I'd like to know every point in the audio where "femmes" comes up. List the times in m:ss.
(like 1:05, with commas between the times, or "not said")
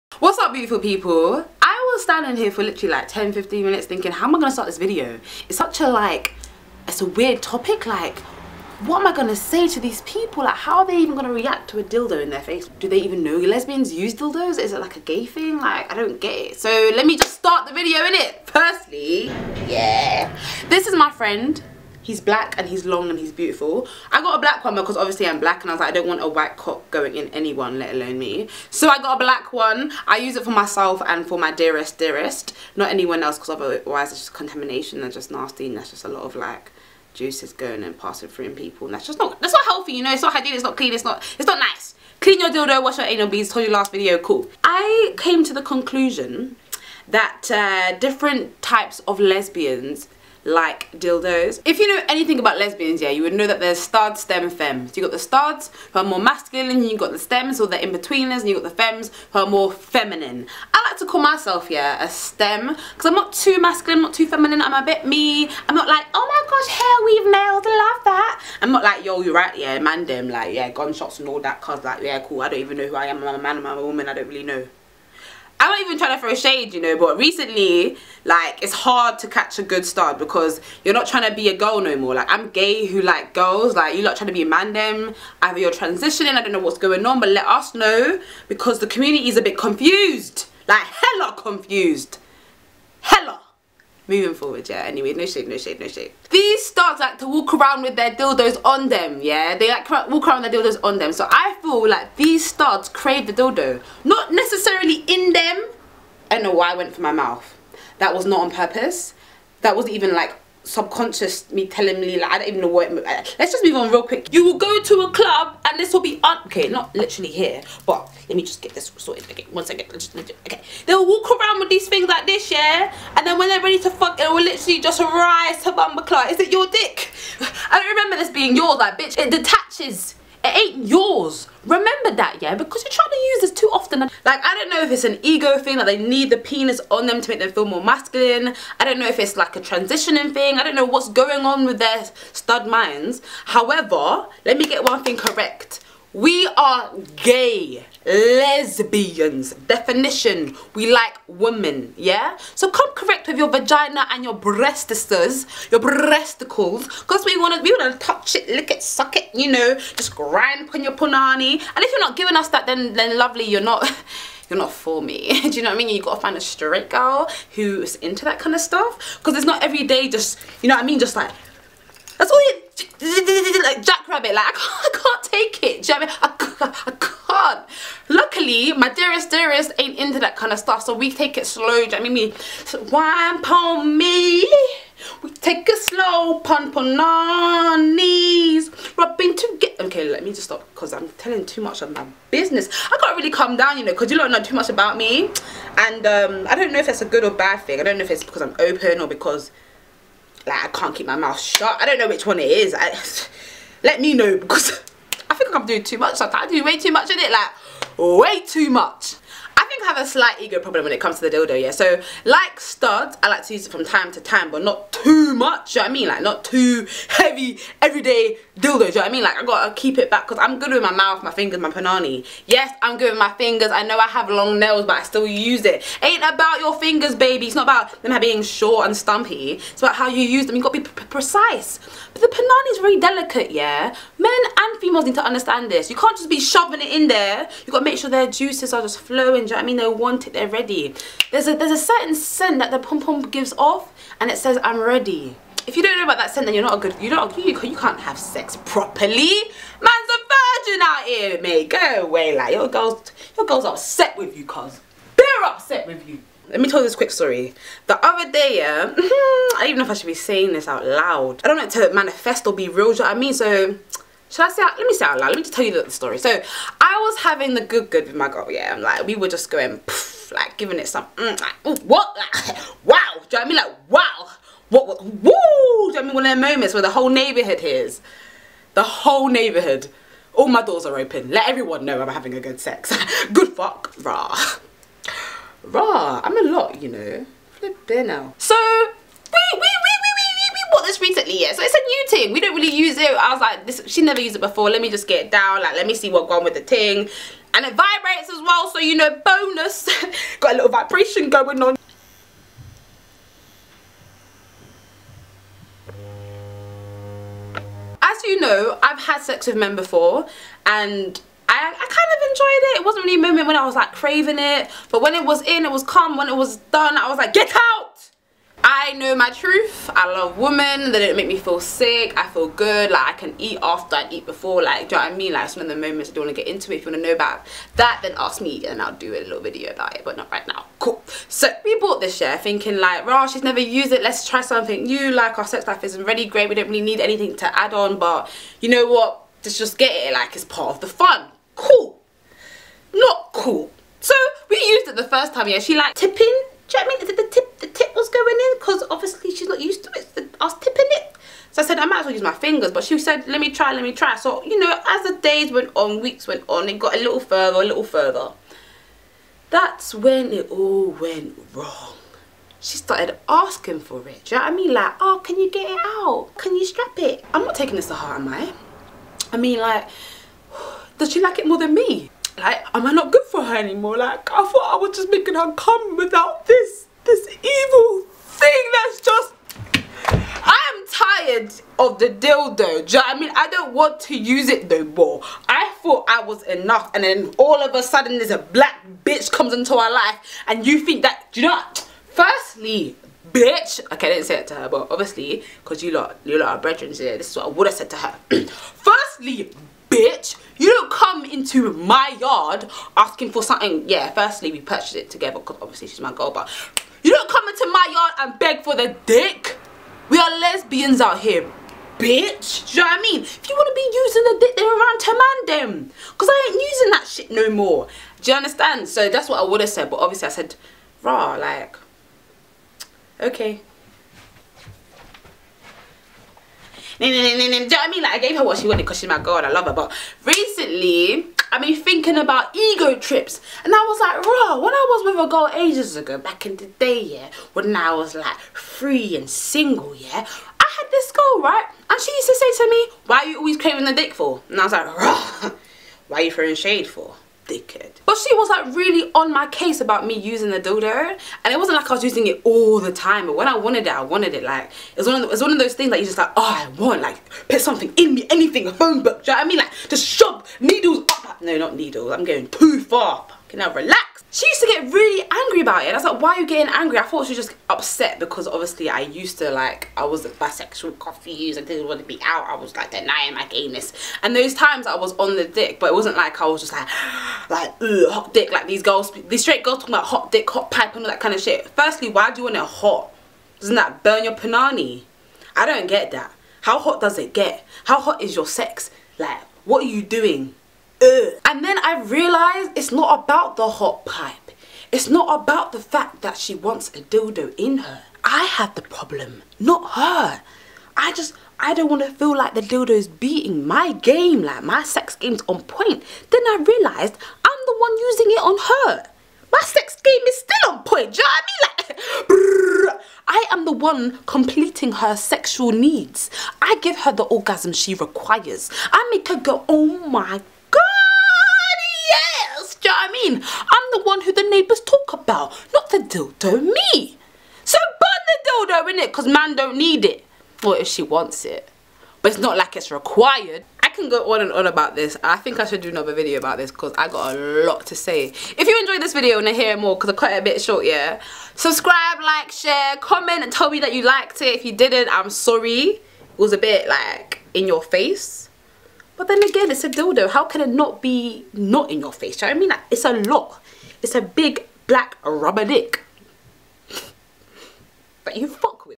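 0:54, 0:58.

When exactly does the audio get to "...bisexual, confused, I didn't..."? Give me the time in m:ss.
7:50.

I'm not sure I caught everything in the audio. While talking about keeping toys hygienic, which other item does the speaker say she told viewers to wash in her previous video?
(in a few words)
anal beads.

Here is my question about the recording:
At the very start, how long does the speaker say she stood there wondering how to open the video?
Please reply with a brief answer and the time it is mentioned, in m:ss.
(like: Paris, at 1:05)
10-15 minutes, at 0:03.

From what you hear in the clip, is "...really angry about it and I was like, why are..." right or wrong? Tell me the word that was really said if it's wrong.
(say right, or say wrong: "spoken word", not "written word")
right.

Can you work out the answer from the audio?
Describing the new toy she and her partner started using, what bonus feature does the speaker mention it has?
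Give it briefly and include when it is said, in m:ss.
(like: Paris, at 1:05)
It vibrates, at 4:57.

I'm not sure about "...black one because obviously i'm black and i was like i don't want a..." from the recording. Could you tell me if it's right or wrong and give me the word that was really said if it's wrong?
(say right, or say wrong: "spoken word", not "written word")
right.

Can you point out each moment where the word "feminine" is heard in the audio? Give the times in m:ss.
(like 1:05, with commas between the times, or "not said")
0:59, 1:04.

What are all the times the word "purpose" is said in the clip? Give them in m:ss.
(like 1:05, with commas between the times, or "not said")
1:48.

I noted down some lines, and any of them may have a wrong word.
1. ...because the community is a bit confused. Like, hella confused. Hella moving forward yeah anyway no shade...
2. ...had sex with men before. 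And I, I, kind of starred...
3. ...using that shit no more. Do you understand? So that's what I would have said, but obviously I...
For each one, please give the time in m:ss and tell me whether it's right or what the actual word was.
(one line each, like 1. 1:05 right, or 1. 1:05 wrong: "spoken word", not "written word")
1. 1:28 right
2. 5:08 wrong: "enjoyed", not "starred"
3. 6:56 right.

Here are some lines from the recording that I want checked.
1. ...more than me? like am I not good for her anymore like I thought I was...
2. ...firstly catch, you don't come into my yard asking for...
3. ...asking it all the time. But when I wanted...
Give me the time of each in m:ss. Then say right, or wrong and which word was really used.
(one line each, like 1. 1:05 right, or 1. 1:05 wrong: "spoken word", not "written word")
1. 6:11 right
2. 6:38 wrong: "bitch", not "catch"
3. 7:32 wrong: "using", not "asking".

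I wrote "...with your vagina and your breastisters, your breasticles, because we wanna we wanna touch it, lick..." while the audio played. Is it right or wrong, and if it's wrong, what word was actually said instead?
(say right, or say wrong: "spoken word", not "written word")
right.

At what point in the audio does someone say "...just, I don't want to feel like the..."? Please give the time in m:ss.
8:21.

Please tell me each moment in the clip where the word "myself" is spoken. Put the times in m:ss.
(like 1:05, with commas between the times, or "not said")
0:30, 1:01.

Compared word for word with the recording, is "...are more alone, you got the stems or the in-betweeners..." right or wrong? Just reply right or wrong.
wrong.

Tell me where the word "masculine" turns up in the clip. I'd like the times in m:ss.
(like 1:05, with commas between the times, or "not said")
0:56, 1:03, 2:17.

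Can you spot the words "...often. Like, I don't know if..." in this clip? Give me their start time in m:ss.
2:13.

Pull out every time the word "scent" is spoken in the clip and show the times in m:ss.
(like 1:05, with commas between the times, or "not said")
4:02, 4:06.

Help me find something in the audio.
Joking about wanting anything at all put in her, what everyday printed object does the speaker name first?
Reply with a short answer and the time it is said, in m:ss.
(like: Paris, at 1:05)
a phone book, at 7:38.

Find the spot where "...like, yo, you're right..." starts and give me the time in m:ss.
1:08.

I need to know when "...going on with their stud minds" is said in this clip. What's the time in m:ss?
2:21.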